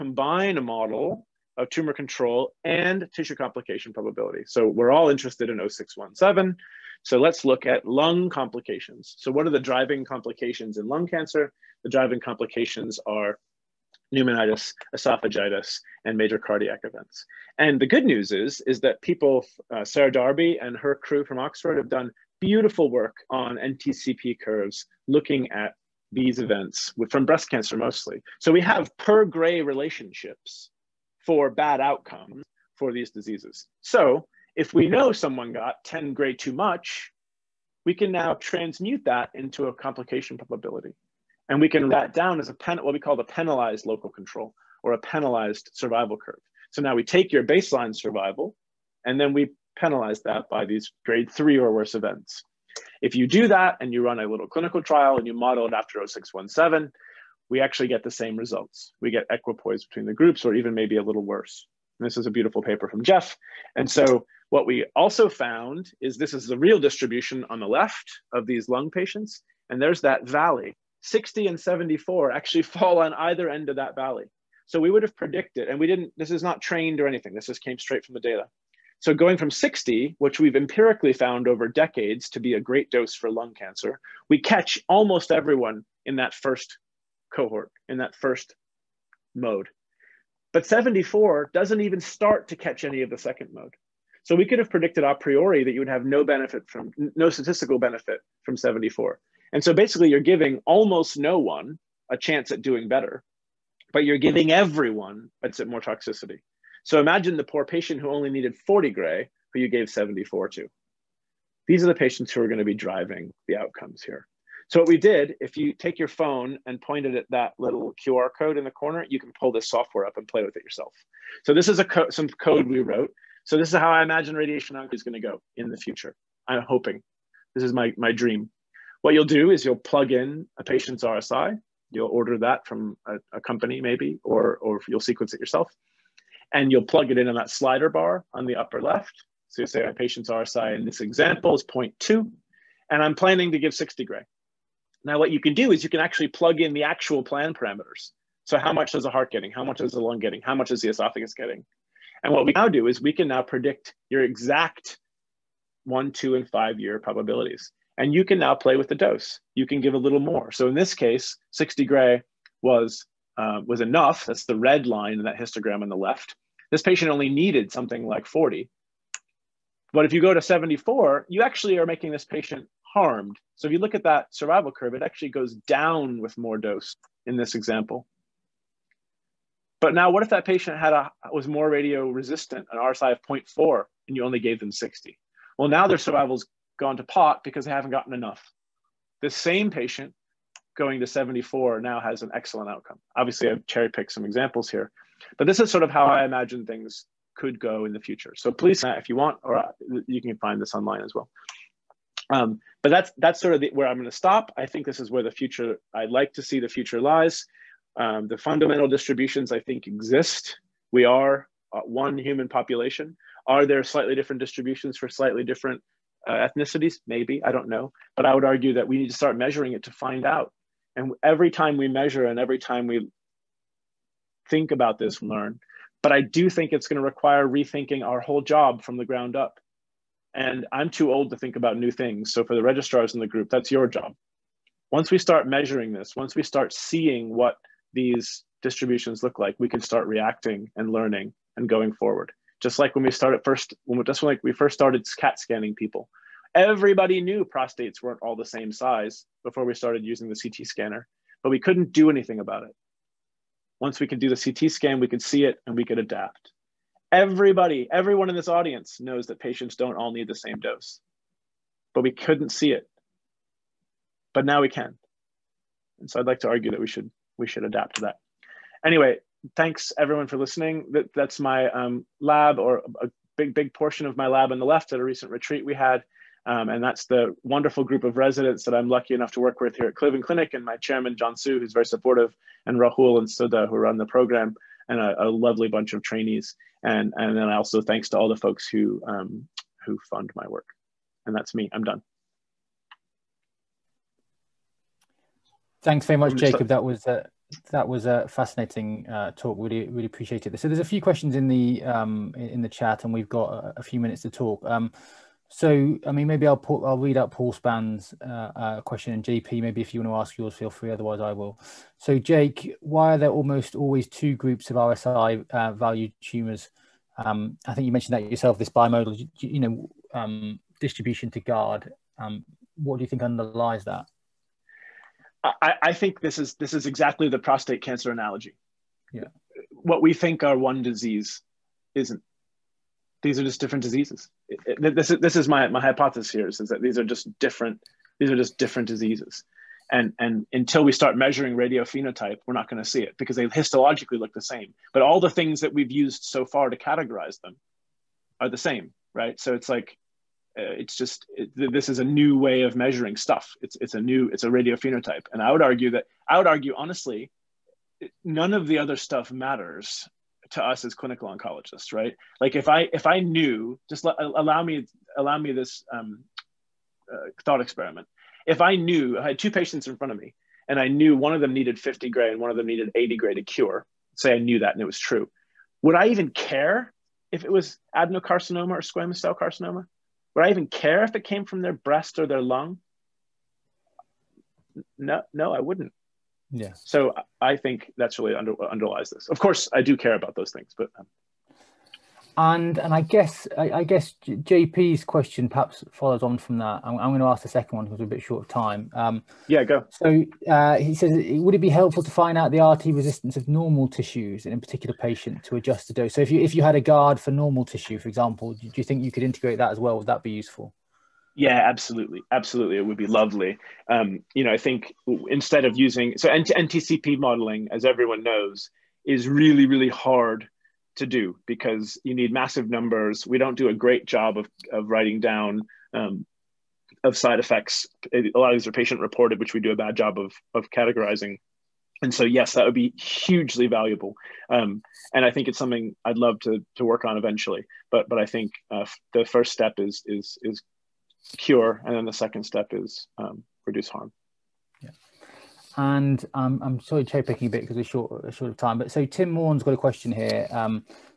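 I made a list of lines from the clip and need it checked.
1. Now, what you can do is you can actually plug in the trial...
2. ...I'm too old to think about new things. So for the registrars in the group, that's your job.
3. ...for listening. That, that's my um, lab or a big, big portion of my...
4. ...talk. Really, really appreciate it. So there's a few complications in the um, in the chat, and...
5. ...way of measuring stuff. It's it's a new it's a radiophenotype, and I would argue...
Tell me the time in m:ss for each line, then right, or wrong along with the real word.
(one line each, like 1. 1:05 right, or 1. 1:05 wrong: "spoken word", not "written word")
1. 2:25 wrong: "actual", not "trial"
2. 3:50 right
3. 4:30 right
4. 4:59 wrong: "questions", not "complications"
5. 5:52 right.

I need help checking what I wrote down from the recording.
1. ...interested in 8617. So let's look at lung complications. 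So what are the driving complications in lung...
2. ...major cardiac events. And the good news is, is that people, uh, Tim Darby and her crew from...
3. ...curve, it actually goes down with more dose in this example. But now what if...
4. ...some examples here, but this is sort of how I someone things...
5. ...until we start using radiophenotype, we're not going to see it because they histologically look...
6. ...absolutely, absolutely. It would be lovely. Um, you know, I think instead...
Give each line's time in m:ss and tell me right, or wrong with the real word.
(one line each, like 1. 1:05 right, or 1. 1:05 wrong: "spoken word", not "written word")
1. 0:05 wrong: "0617", not "8617"
2. 0:16 wrong: "Sarah", not "Tim"
3. 2:54 right
4. 3:14 wrong: "imagine", not "someone"
5. 5:40 wrong: "measuring", not "using"
6. 6:51 right.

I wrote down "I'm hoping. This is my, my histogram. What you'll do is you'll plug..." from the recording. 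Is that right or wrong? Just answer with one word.
wrong.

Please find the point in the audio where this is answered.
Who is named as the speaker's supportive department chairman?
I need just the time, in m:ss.
4:41.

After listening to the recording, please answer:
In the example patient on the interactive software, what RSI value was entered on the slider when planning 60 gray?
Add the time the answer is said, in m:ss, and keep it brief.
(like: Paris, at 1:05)
0.2, at 2:21.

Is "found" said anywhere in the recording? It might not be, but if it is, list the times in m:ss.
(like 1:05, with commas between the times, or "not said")
1:05, 1:21.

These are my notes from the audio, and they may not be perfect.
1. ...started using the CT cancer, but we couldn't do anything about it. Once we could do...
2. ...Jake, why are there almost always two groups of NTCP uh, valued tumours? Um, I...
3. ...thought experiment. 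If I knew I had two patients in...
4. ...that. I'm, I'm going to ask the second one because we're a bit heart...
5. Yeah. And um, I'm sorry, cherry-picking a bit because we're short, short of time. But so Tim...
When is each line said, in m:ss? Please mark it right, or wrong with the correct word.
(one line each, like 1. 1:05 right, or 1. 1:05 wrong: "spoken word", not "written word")
1. 4:09 wrong: "scanner", not "cancer"
2. 5:12 wrong: "RSI", not "NTCP"
3. 6:07 right
4. 6:36 wrong: "short", not "heart"
5. 7:24 right.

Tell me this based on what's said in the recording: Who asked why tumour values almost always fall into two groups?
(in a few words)
Paul Span.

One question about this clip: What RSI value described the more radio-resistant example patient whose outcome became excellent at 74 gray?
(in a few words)
0.4.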